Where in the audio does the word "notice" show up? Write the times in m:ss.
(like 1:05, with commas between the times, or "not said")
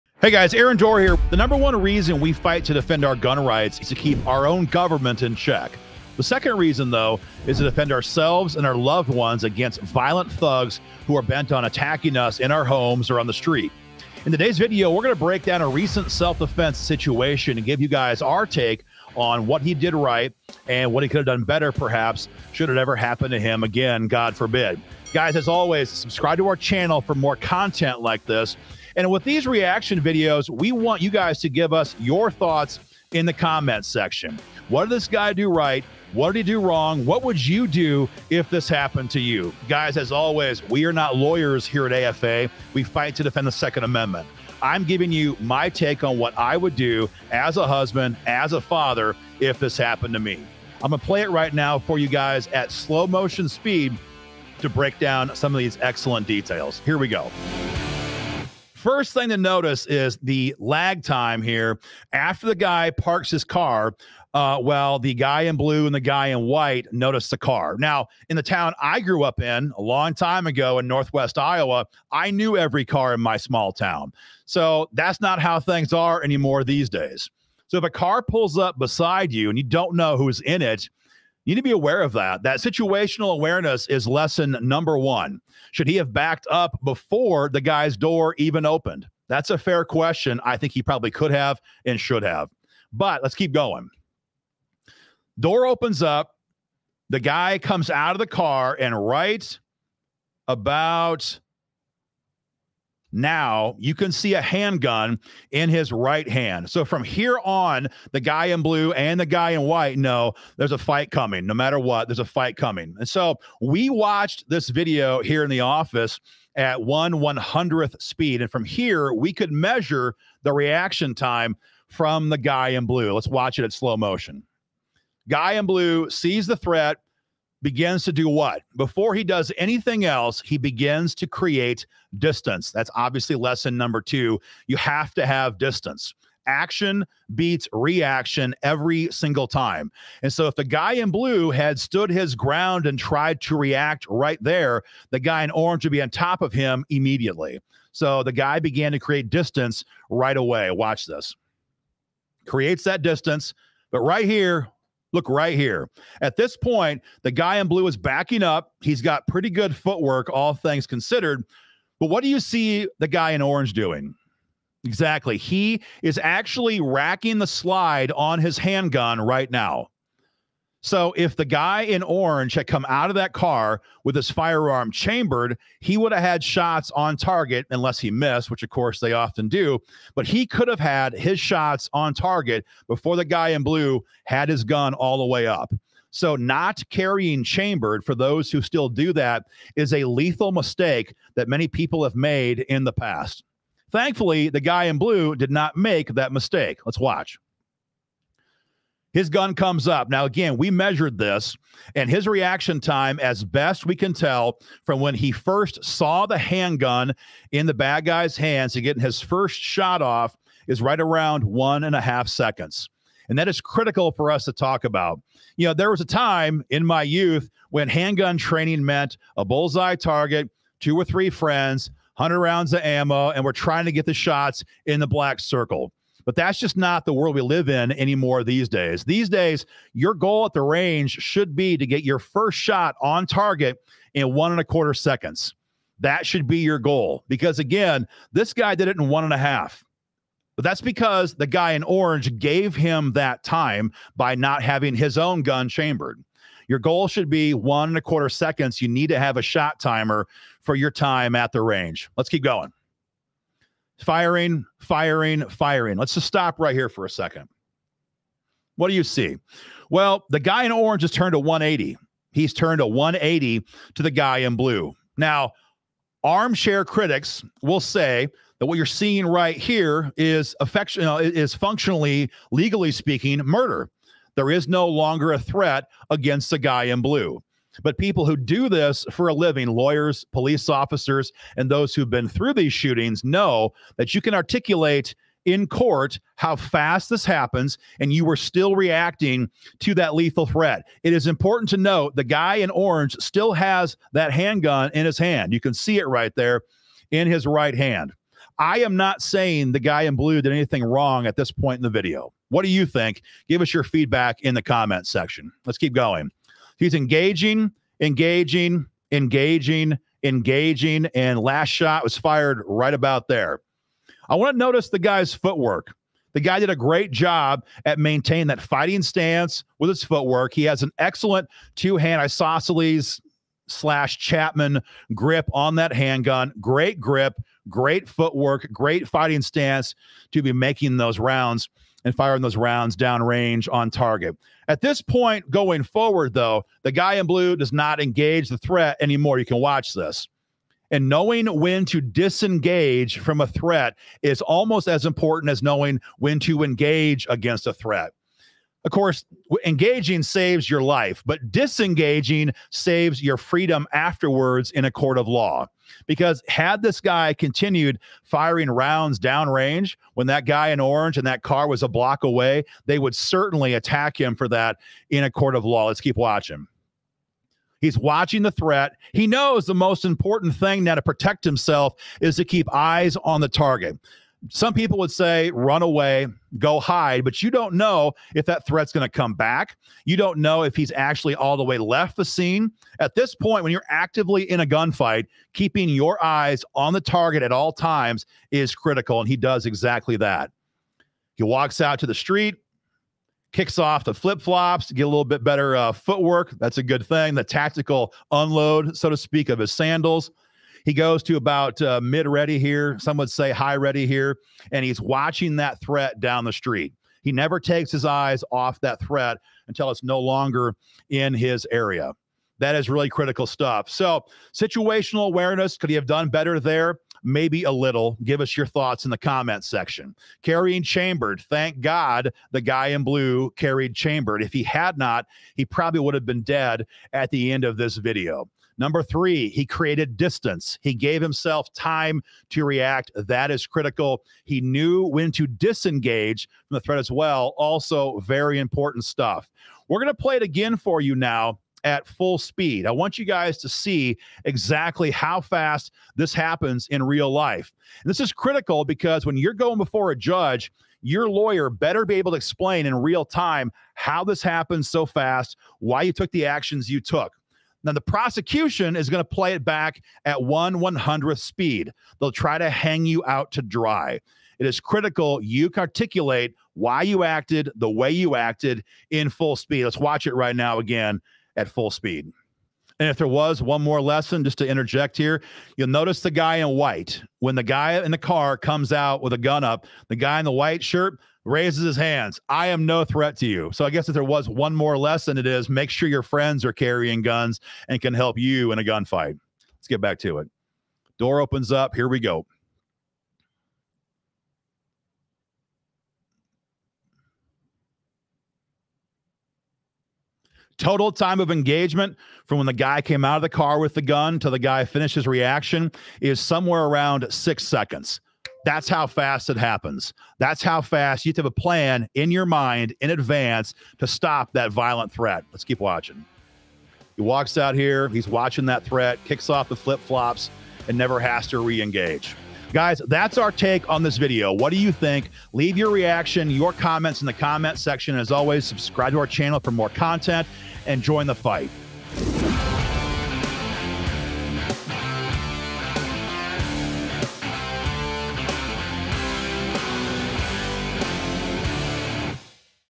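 0:59, 1:06, 5:14, 7:55.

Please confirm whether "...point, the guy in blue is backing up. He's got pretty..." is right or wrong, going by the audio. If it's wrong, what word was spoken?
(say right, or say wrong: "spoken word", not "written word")
right.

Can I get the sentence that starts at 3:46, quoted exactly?
But that's just not the world we live in anymore these days.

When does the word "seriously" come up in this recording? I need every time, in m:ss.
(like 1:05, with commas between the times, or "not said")
not said.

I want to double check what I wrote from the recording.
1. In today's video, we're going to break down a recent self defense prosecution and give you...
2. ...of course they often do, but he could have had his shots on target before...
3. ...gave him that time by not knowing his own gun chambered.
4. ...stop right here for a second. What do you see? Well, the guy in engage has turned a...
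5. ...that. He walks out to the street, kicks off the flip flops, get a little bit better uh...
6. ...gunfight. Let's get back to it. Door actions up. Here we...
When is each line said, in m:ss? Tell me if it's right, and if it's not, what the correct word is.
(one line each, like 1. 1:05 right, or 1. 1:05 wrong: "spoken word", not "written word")
1. 0:14 wrong: "situation", not "prosecution"
2. 2:58 right
3. 4:02 wrong: "having", not "knowing"
4. 4:16 wrong: "orange", not "engage"
5. 6:30 right
6. 8:08 wrong: "opens", not "actions".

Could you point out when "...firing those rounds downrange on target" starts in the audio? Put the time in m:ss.
5:32.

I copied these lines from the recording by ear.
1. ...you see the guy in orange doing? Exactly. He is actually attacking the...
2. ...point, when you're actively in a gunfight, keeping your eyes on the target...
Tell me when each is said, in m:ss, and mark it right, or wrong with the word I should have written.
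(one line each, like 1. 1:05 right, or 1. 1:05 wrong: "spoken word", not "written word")
1. 2:42 wrong: "racking", not "attacking"
2. 6:23 right.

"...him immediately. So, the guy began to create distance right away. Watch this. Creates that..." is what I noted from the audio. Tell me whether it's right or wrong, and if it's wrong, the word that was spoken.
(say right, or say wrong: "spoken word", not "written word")
right.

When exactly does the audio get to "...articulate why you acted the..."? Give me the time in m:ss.
7:45.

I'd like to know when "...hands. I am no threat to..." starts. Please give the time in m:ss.
8:01.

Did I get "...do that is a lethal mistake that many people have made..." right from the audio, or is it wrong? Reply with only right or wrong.
right.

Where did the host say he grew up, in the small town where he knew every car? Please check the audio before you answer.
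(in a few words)
Northwest Iowa.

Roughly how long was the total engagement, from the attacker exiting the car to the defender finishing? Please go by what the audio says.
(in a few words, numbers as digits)
6 seconds.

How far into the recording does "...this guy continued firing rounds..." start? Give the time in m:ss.
5:56.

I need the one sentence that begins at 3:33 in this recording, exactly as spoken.
And that is critical for us to talk about.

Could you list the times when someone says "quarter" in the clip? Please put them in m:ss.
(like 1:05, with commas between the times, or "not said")
3:54, 4:08.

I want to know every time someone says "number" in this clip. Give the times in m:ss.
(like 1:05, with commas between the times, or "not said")
0:01, 1:24, 2:13, 7:08.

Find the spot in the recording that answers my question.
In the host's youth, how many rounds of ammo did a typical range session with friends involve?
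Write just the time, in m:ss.
3:42.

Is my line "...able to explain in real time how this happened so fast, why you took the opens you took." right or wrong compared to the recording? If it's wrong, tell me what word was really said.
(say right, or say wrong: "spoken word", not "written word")
wrong: "actions", not "opens".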